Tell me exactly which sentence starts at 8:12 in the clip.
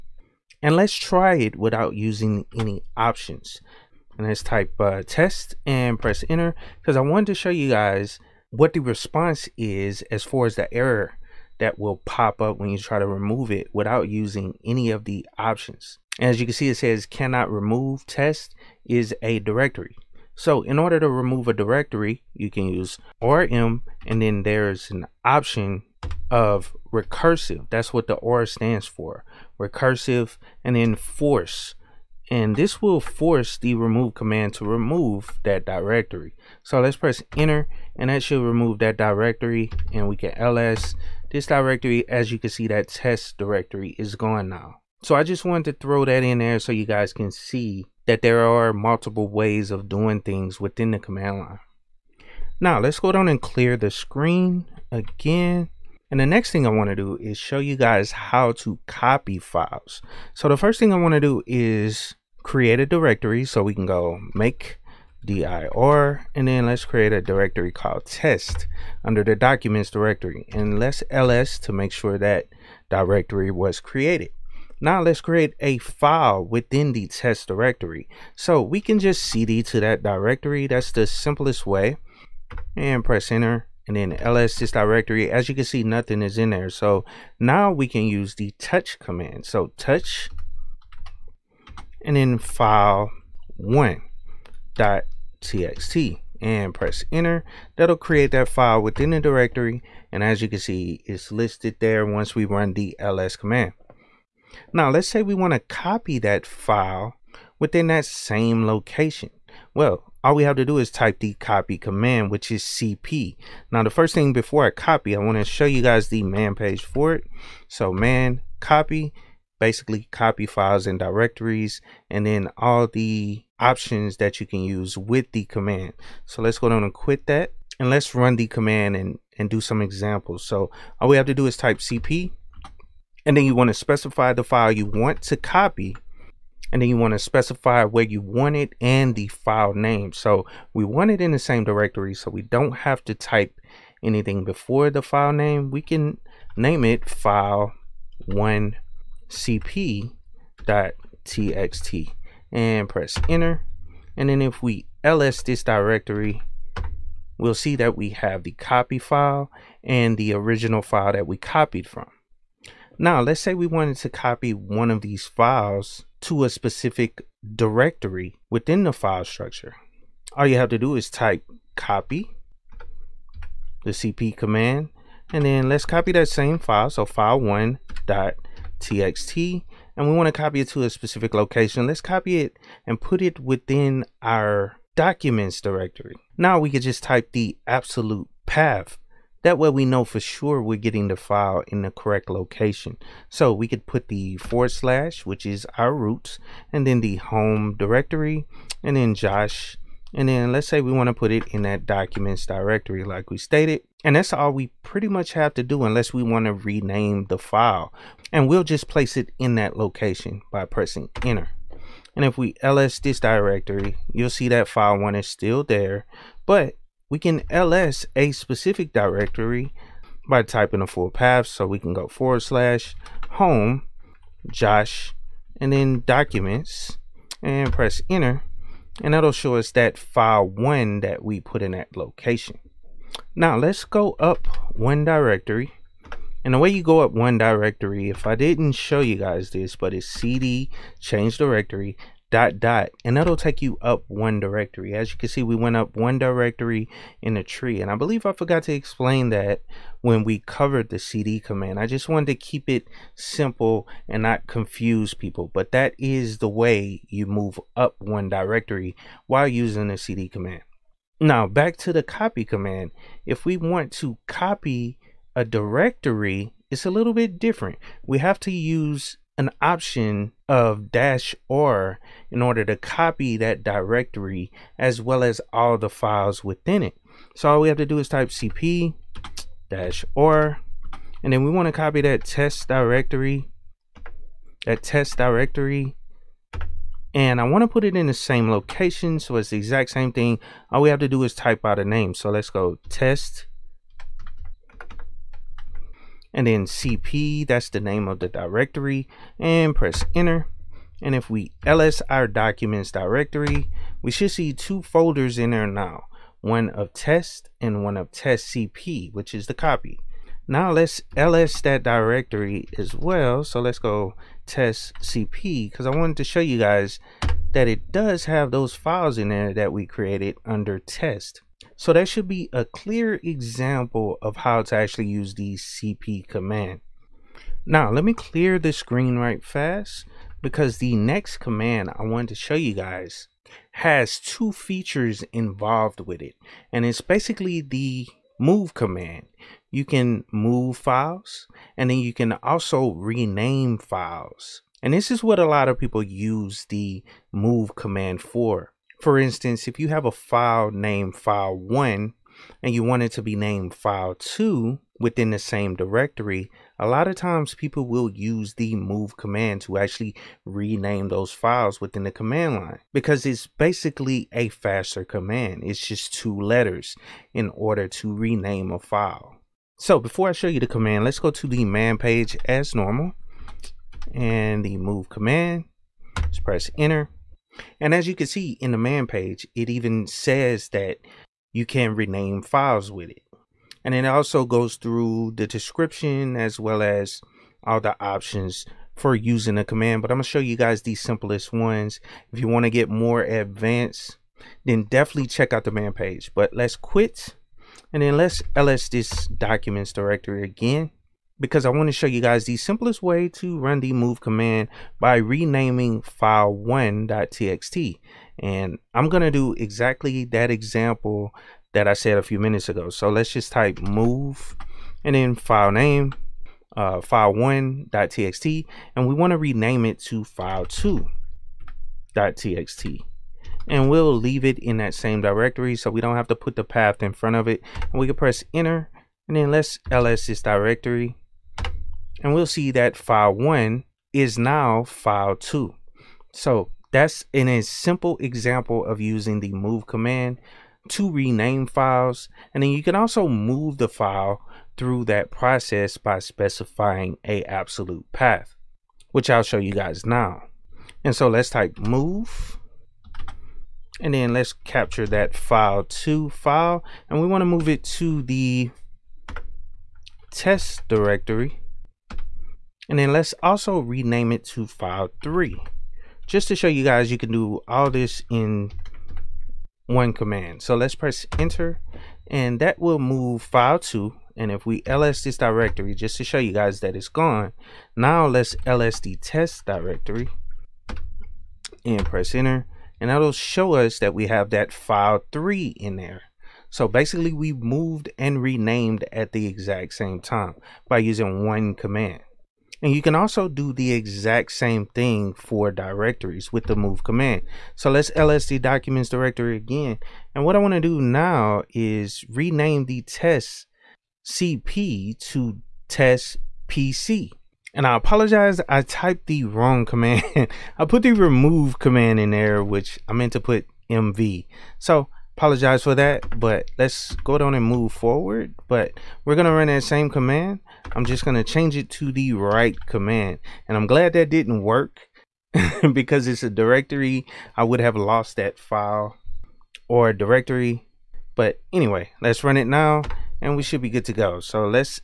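And you can also do the exact same thing for directories with the move command.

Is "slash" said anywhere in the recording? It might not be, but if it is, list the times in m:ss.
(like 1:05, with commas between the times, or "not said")
3:14, 3:42.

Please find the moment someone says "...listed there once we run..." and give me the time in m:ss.
1:41.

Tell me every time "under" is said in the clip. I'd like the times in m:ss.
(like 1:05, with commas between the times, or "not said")
1:09, 5:20.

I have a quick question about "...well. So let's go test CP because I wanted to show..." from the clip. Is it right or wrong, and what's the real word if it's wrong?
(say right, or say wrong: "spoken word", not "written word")
right.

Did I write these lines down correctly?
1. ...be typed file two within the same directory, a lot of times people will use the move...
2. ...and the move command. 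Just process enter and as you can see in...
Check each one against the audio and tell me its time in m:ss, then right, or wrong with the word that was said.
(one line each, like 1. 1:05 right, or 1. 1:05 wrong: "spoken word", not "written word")
1. 5:53 wrong: "named", not "typed"
2. 6:14 wrong: "press", not "process".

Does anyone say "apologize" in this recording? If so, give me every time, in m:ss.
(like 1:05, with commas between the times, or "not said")
8:27, 8:35.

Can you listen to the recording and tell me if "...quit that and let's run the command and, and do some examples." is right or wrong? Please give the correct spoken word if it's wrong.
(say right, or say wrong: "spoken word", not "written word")
right.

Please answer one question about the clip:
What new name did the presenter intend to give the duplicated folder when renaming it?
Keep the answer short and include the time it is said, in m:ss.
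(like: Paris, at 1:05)
test PC, at 8:25.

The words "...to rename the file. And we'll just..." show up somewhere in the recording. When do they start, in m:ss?
3:26.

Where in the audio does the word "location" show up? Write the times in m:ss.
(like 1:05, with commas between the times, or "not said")
1:48, 3:01, 3:12, 3:29, 3:51, 4:48.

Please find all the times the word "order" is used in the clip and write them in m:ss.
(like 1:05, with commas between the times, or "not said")
0:20, 4:32, 6:07.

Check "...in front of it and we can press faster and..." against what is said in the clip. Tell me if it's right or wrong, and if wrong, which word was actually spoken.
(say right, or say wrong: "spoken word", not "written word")
wrong: "enter", not "faster".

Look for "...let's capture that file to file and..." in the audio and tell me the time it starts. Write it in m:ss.
7:34.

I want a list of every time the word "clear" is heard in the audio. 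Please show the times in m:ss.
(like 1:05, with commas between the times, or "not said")
0:53, 5:22, 5:28.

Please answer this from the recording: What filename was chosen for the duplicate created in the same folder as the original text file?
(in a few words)
file1cp.txt.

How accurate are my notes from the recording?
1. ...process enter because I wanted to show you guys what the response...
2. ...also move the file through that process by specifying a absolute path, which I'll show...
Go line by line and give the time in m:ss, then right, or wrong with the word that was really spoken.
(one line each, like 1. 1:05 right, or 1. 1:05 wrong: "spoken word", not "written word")
1. 0:05 wrong: "press", not "process"
2. 7:22 right.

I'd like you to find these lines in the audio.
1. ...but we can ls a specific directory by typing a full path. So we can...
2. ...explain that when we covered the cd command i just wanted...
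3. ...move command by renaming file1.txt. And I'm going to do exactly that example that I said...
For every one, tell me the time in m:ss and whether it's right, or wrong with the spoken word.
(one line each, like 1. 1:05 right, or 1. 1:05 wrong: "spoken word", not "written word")
1. 3:36 right
2. 4:08 right
3. 6:43 right.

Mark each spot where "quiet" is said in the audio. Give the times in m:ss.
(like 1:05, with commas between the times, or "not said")
not said.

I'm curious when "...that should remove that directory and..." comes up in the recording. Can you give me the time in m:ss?
0:38.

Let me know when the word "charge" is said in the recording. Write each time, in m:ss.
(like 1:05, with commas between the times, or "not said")
not said.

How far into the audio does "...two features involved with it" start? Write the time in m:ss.
5:34.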